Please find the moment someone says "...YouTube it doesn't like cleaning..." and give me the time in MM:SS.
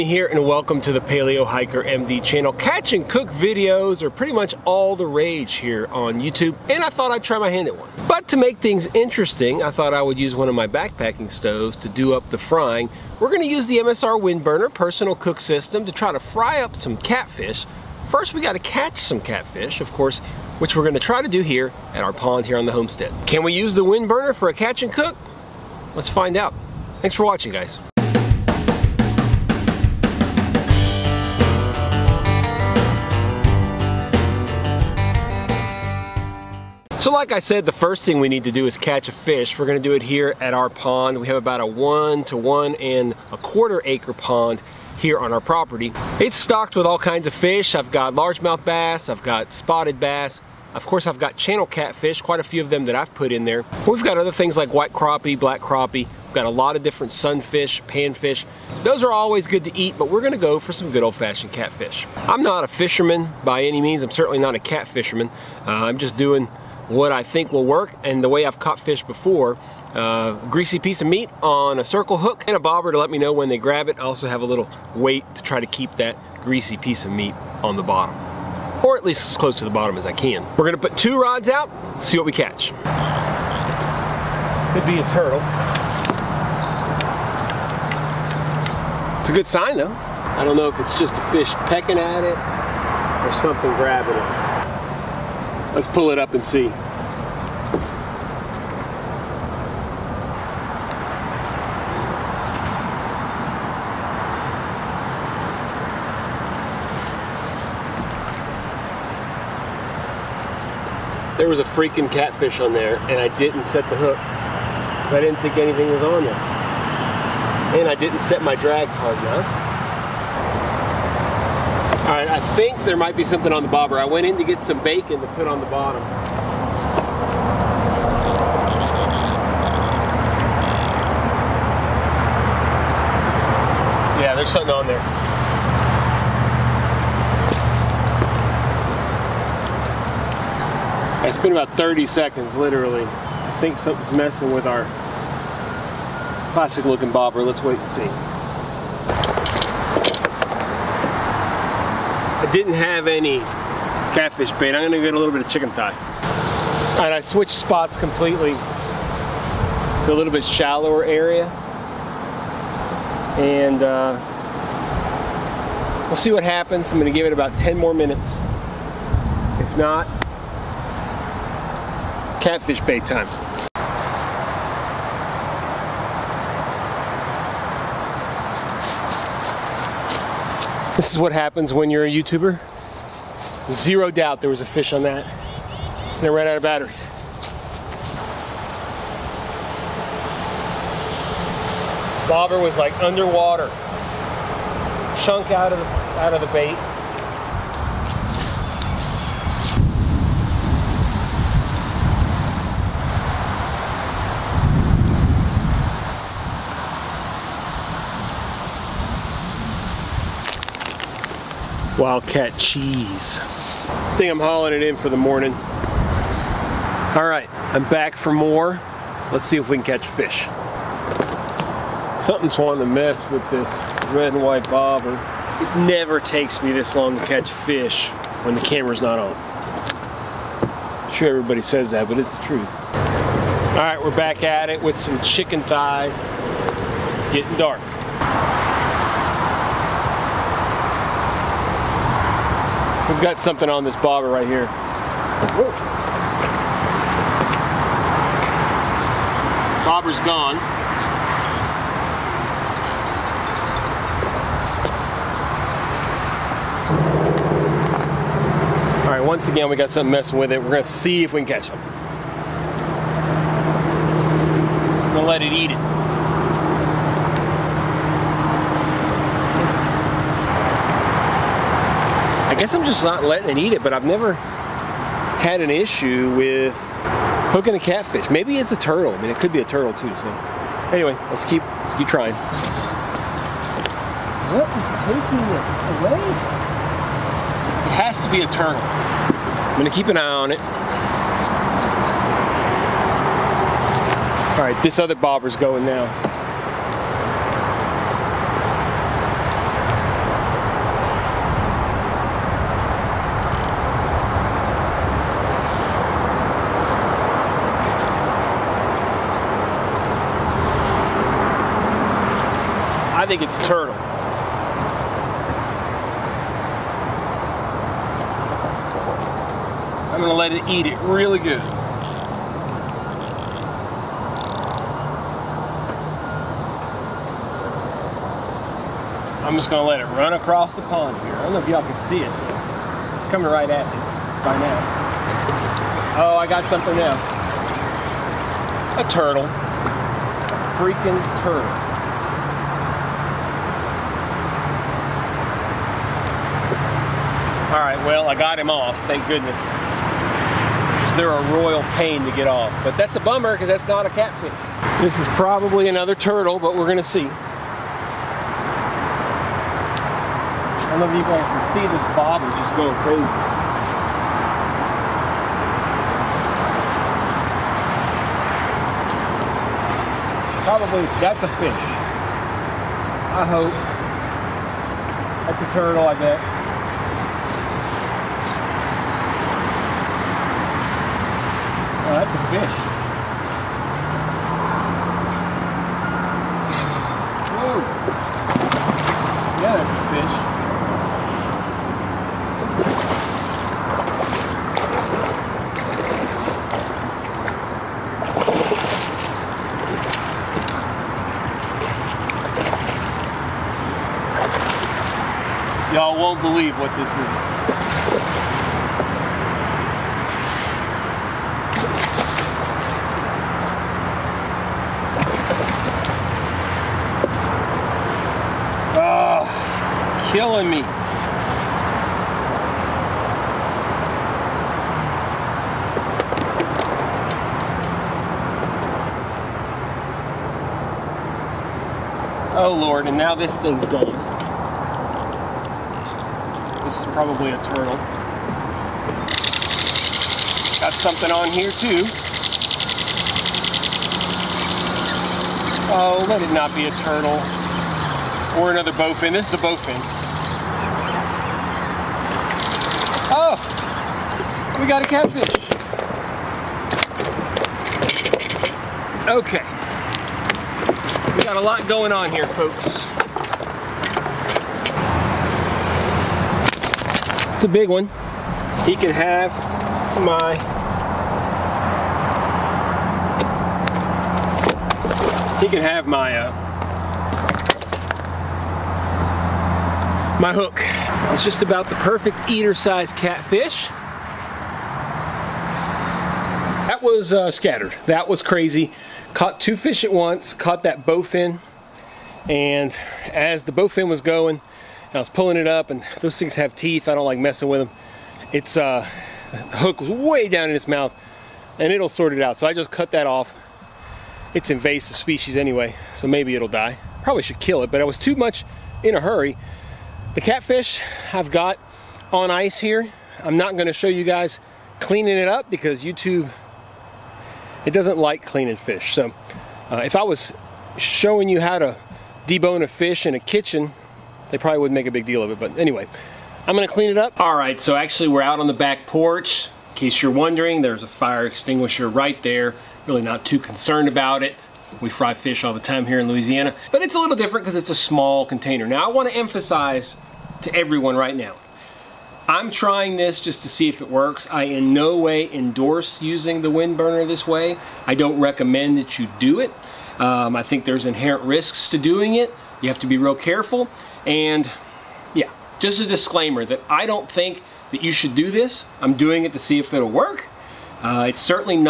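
08:36.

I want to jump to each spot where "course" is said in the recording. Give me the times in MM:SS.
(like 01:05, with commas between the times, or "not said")
00:19, 00:50.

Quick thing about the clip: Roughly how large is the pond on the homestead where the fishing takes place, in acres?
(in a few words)
1 to 1.25 acres.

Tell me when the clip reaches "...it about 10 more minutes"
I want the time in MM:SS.
02:47.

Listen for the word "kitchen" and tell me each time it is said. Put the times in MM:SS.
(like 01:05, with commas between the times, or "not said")
08:43.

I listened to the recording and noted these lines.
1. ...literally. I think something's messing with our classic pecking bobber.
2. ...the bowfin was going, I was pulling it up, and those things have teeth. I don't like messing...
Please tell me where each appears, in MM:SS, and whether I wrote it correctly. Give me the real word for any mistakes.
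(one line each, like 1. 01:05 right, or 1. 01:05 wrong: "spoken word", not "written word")
1. 02:22 wrong: "looking", not "pecking"
2. 08:13 right.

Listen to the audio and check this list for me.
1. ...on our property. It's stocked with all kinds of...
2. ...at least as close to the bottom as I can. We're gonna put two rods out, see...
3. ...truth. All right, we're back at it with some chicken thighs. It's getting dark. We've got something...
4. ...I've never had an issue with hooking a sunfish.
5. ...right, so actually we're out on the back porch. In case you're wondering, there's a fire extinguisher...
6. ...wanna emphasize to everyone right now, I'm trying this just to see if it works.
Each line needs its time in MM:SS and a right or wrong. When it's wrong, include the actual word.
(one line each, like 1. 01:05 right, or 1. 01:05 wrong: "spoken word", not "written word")
1. 00:45 right
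2. 01:18 right
3. 03:52 right
4. 04:33 wrong: "catfish", not "sunfish"
5. 08:47 right
6. 08:59 right.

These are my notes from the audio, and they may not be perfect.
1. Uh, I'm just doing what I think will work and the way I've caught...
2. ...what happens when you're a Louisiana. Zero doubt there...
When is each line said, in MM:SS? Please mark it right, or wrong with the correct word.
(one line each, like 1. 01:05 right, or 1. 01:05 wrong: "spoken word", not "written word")
1. 01:05 right
2. 03:01 wrong: "YouTuber", not "Louisiana".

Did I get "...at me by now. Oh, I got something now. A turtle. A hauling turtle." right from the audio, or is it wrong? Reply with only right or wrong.
wrong.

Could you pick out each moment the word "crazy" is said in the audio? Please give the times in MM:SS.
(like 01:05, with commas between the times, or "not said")
06:03, 08:08.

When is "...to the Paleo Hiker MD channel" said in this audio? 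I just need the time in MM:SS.
00:00.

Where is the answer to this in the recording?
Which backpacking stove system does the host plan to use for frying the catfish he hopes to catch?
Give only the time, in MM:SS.
00:13.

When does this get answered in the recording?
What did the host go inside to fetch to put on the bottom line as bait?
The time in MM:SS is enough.
02:04.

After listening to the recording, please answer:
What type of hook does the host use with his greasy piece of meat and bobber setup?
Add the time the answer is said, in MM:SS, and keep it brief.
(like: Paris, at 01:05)
circle hook, at 01:11.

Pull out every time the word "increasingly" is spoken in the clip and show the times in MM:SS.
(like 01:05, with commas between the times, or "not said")
not said.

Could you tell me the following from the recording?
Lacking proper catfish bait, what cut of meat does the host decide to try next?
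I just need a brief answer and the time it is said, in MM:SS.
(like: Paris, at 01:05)
chicken thigh, at 02:35.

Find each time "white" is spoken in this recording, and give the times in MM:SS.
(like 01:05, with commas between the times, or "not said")
00:54, 03:44.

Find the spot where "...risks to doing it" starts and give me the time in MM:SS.
09:11.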